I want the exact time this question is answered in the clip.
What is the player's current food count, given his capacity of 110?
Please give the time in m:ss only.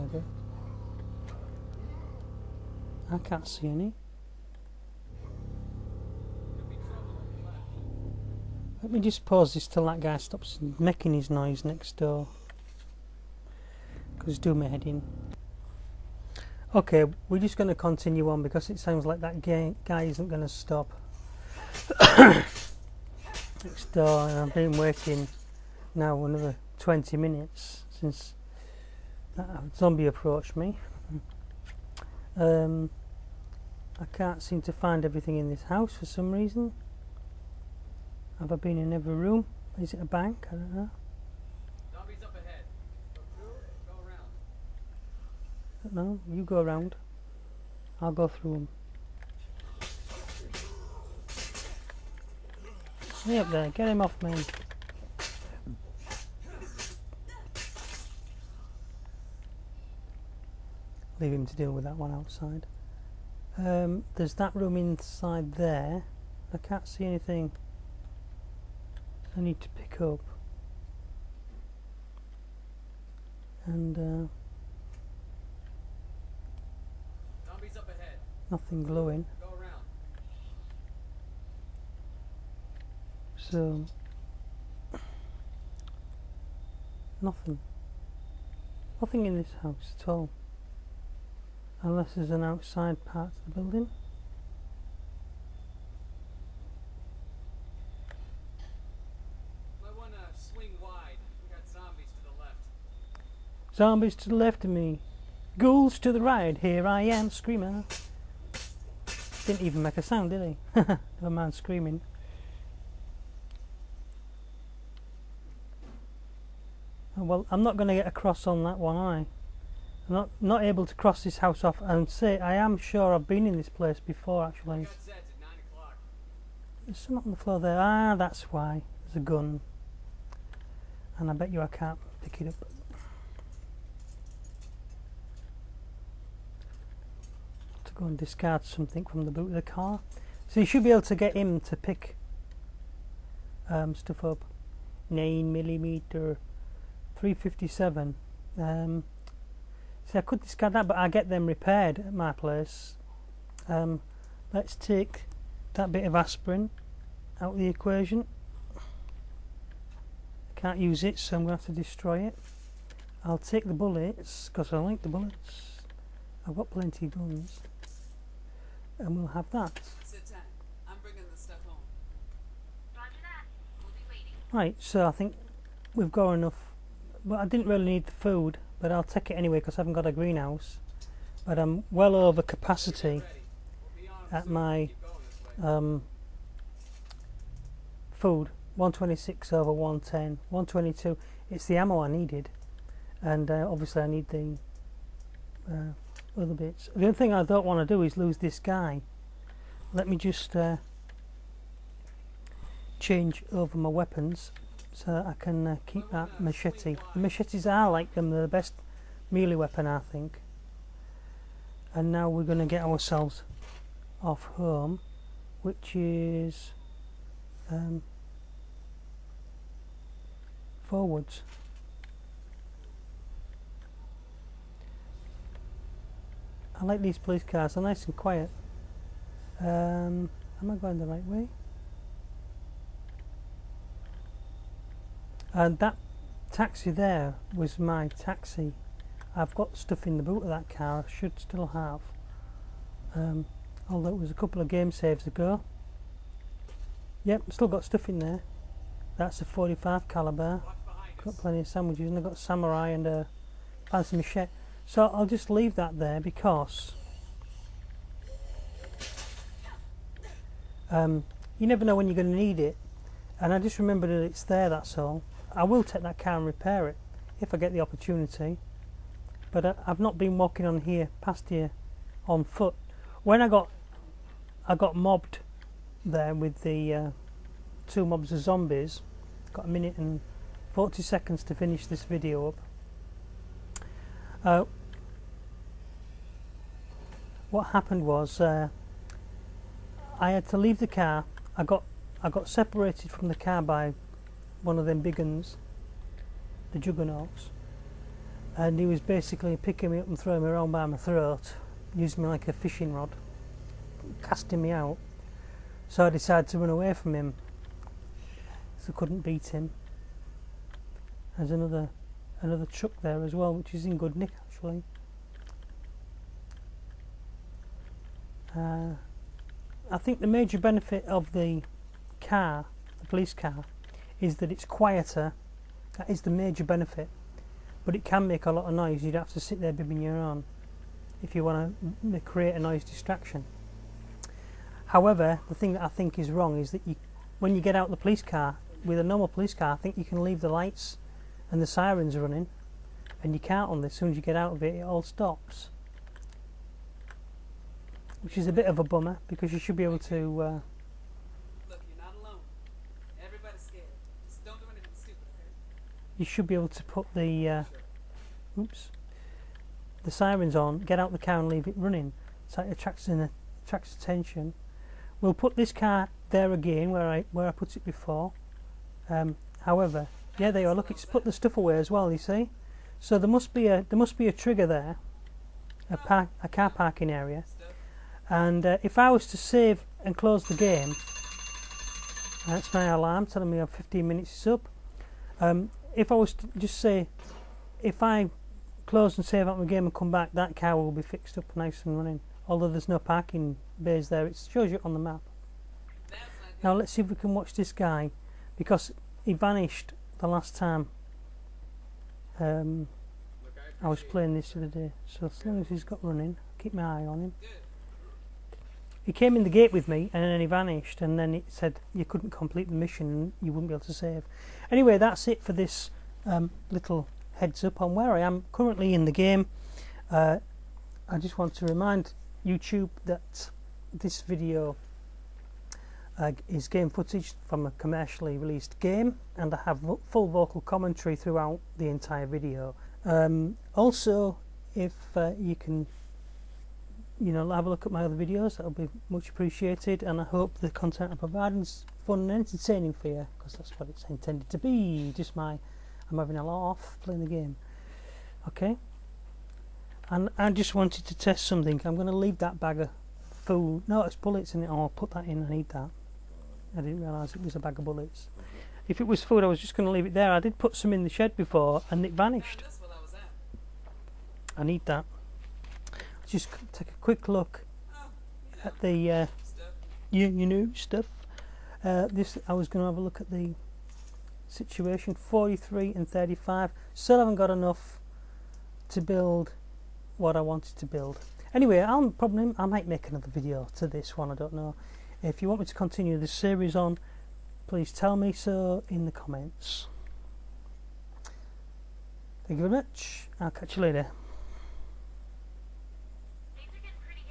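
3:08.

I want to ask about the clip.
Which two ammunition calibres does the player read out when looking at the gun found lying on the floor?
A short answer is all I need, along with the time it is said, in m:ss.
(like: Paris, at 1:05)
9 millimeter 357, at 2:25.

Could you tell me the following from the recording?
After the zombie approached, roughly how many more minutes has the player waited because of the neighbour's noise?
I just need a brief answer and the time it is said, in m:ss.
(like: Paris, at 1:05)
20, at 0:26.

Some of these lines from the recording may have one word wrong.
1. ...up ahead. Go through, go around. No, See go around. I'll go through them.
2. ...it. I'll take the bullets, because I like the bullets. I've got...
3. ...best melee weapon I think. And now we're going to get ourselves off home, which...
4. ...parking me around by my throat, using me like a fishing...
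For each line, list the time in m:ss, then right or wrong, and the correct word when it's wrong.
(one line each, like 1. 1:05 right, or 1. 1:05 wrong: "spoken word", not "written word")
1. 0:42 wrong: "You", not "See"
2. 2:42 right
3. 3:28 right
4. 5:00 wrong: "throwing", not "parking".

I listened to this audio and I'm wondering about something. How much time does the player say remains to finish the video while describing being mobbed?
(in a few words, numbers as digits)
1 minute 40 seconds.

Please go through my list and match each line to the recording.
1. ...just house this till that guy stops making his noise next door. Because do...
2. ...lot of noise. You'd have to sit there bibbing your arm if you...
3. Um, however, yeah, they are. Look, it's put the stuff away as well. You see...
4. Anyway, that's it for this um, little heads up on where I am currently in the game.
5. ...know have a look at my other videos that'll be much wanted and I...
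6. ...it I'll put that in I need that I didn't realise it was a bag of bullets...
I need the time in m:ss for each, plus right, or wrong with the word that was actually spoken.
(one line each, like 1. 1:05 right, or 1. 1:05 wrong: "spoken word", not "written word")
1. 0:08 wrong: "pause", not "house"
2. 5:28 right
3. 6:09 right
4. 6:54 right
5. 7:17 wrong: "appreciated", not "wanted"
6. 7:34 right.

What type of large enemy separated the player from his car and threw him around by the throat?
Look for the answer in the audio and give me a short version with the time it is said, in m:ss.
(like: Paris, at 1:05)
juggernauts, at 4:56.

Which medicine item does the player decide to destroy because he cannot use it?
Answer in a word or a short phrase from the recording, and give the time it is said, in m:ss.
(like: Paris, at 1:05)
aspirin, at 2:36.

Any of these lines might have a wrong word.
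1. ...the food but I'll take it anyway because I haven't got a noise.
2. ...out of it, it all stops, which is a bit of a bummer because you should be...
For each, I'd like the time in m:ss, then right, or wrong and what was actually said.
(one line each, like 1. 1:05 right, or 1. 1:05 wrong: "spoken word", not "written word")
1. 2:58 wrong: "greenhouse", not "noise"
2. 5:44 right.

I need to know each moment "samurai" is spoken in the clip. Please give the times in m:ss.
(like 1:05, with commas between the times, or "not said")
4:12.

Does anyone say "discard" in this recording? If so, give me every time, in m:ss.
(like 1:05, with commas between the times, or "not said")
2:18, 2:30.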